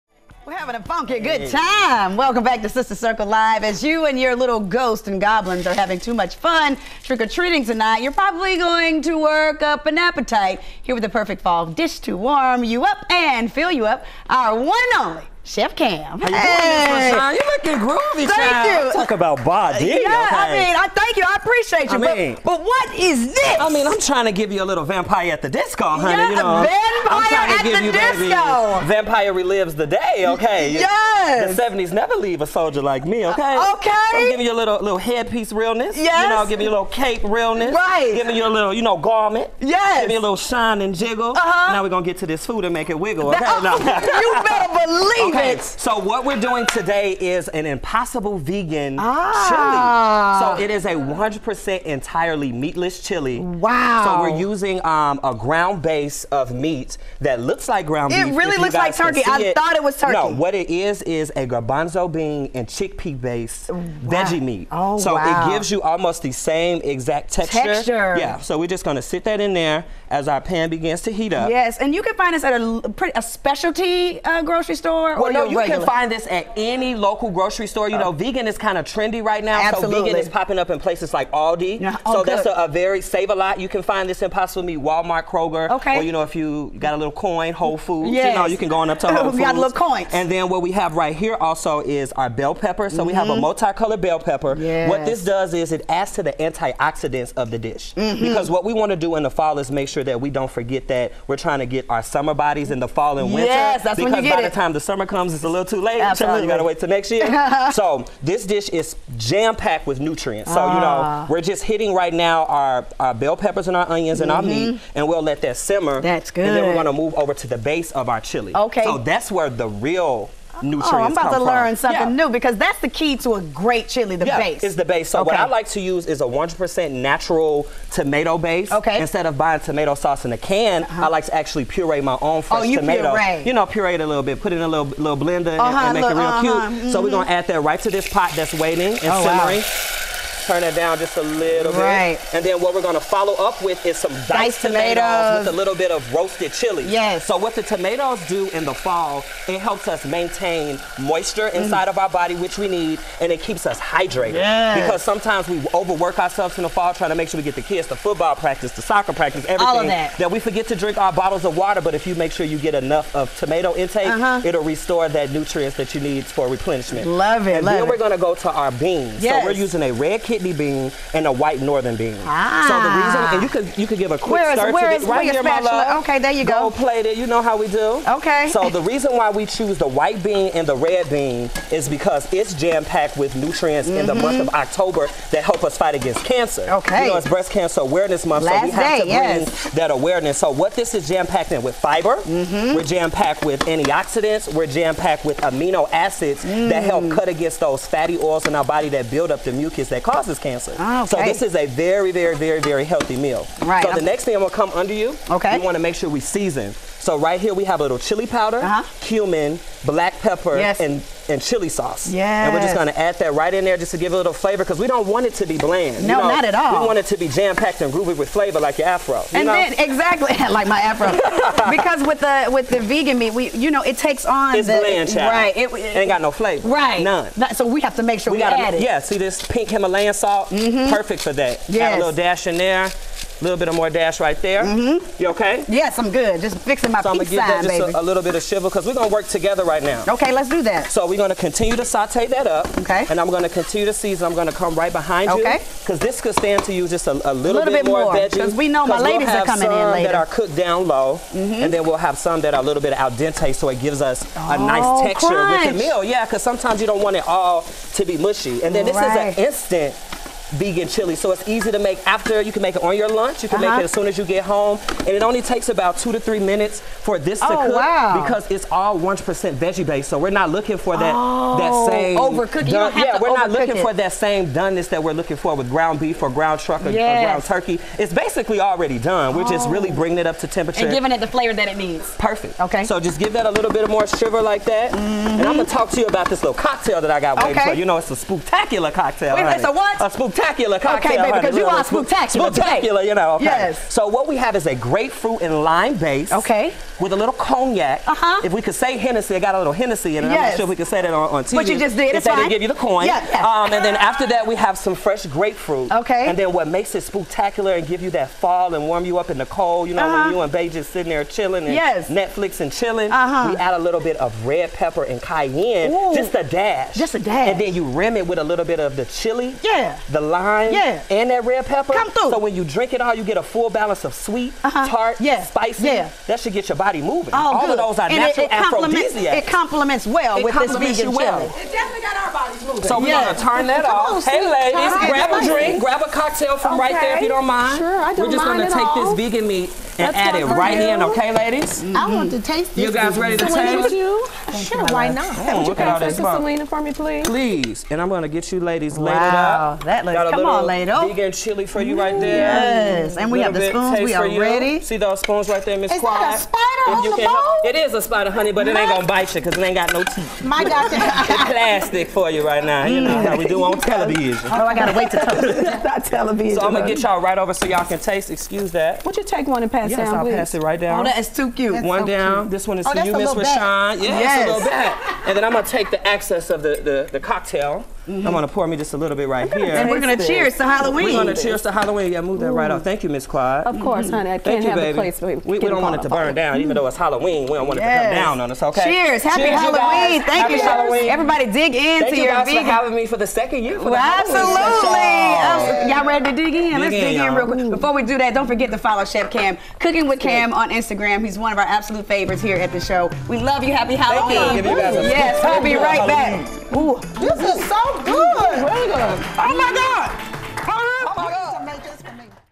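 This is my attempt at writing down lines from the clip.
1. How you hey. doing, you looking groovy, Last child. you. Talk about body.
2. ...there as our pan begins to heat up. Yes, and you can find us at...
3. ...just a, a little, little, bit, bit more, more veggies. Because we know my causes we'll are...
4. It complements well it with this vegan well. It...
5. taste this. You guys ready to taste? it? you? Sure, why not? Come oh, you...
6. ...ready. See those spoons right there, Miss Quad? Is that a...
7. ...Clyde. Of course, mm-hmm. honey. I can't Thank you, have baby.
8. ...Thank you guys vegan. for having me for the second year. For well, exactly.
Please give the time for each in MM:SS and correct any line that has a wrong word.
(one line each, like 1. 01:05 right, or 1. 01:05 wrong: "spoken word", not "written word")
1. 00:16 wrong: "Thank", not "Last"
2. 01:09 right
3. 04:06 wrong: "ladies", not "causes"
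4. 05:29 right
5. 05:42 right
6. 05:54 right
7. 06:23 right
8. 06:32 wrong: "absolutely", not "exactly".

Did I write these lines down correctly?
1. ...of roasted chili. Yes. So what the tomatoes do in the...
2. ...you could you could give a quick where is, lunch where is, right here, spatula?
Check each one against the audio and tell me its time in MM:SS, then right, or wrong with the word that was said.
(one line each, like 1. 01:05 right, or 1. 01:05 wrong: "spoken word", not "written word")
1. 02:25 right
2. 02:53 wrong: "search", not "lunch".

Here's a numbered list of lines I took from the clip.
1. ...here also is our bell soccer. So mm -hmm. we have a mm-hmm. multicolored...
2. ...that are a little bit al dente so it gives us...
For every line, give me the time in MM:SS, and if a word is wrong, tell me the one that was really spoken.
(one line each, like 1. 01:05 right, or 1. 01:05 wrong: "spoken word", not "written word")
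1. 01:31 wrong: "pepper", not "soccer"
2. 04:12 right.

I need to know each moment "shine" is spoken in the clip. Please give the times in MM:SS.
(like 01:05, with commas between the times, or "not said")
00:40.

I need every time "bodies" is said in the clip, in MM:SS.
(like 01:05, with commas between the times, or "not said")
01:42, 05:32.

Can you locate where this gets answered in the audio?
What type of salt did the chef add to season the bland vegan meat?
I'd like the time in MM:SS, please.
03:49.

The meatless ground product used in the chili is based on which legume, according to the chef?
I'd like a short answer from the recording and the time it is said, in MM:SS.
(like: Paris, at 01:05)
Garbanzo bean, at 01:01.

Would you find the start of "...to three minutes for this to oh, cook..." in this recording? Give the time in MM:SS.
04:26.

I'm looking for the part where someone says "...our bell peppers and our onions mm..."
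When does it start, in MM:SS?
01:52.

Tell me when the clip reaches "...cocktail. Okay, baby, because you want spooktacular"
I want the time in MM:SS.
04:50.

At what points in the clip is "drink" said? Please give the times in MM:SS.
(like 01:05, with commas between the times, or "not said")
02:40, 05:22, 05:35.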